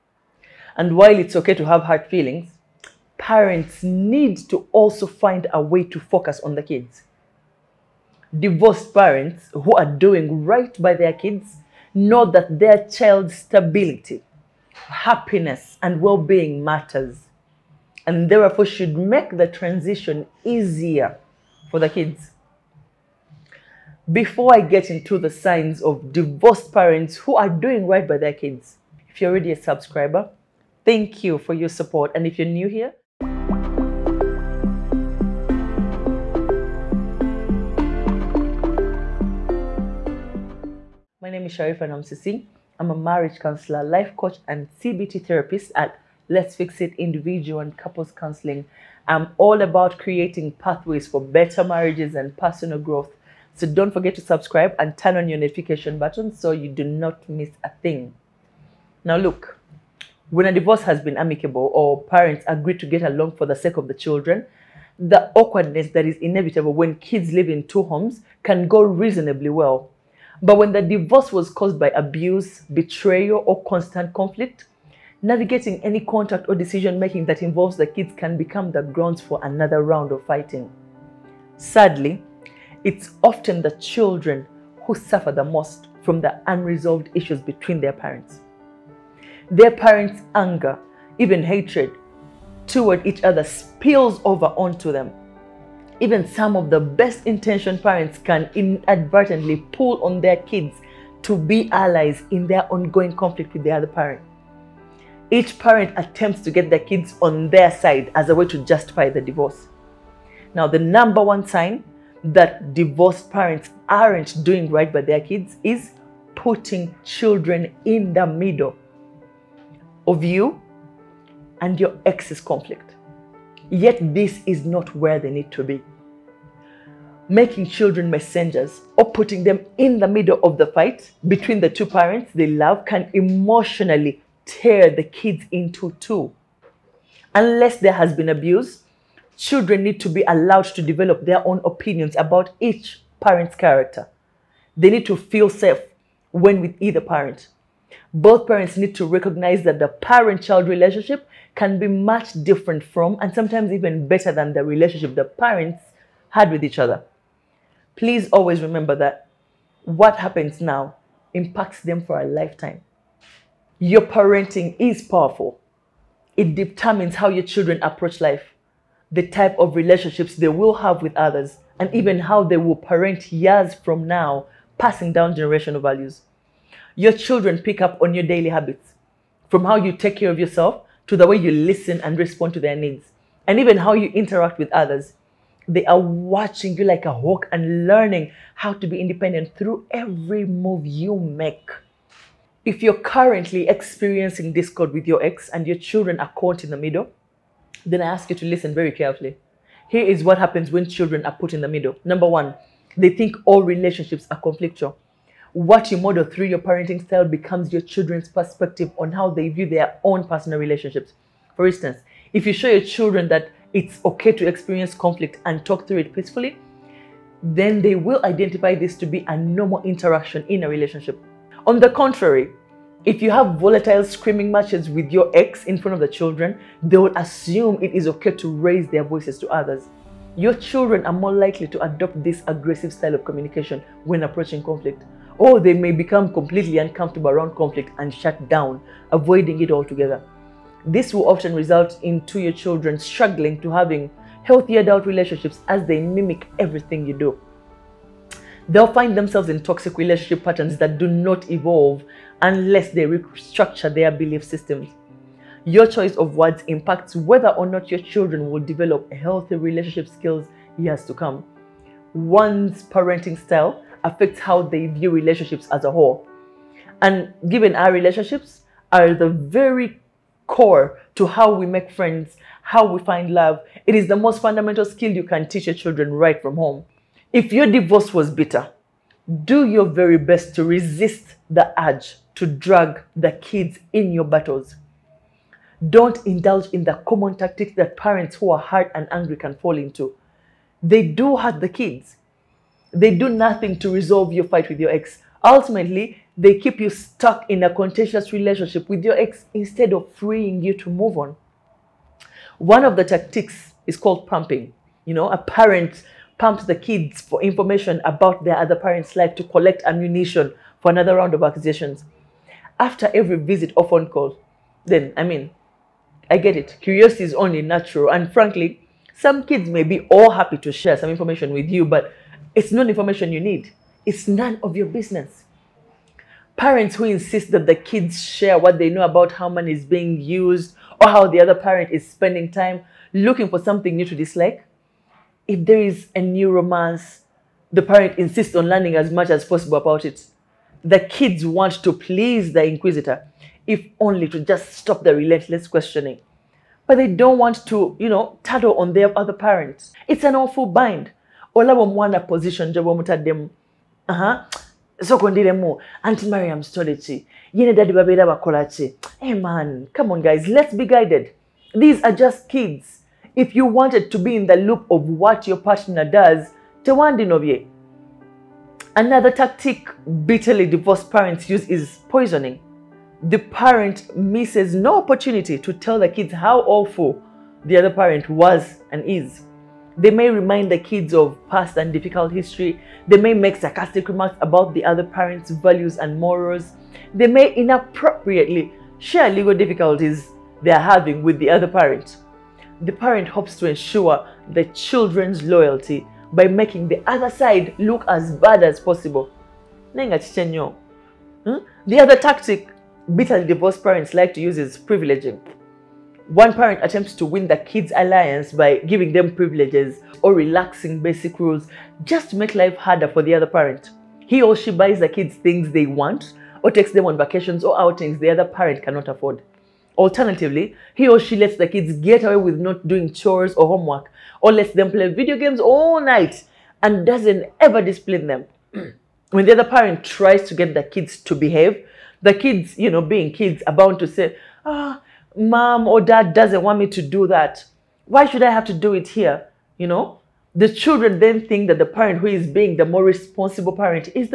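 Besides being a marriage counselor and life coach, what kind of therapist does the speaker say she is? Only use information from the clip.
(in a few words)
CBT therapist.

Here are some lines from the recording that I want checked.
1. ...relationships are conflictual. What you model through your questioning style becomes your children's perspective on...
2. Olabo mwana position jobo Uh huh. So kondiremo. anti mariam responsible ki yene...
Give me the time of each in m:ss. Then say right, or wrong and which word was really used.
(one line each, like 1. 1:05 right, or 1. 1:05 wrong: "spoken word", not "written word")
1. 3:23 wrong: "parenting", not "questioning"
2. 5:51 wrong: "stole", not "responsible".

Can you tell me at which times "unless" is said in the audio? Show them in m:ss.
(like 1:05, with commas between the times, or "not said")
2:17, 4:12.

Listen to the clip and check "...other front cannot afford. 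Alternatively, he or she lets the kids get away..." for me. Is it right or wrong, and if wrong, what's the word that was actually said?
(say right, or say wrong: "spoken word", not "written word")
wrong: "parent", not "front".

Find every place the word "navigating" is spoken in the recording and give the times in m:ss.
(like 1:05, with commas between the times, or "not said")
1:15.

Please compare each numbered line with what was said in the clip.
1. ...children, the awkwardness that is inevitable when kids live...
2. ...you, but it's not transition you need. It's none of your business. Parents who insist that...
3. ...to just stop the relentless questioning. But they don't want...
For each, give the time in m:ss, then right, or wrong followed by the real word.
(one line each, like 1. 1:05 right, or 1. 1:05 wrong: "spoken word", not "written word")
1. 1:03 right
2. 5:21 wrong: "information", not "transition"
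3. 5:44 right.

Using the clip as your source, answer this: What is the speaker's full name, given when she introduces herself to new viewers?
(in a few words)
Sharifah Namusisi.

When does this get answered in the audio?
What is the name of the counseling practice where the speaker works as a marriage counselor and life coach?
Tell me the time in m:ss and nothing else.
0:46.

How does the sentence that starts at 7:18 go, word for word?
Why should I have to do it here?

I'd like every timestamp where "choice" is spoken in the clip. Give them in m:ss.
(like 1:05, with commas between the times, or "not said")
4:15.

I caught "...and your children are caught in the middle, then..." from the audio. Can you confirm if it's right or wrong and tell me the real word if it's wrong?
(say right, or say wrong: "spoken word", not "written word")
right.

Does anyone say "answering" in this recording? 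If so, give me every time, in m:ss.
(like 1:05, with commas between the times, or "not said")
not said.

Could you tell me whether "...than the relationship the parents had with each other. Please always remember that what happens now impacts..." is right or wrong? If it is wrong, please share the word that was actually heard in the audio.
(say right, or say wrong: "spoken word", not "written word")
right.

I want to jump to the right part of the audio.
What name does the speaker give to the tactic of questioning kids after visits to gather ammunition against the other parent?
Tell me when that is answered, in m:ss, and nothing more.
5:04.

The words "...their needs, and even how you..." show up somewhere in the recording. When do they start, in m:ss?
3:02.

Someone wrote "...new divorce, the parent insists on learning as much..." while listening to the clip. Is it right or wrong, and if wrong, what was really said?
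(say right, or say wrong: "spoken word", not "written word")
wrong: "romance", not "divorce".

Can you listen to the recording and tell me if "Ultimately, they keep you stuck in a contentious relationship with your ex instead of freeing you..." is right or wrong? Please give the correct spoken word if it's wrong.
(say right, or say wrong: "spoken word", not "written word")
right.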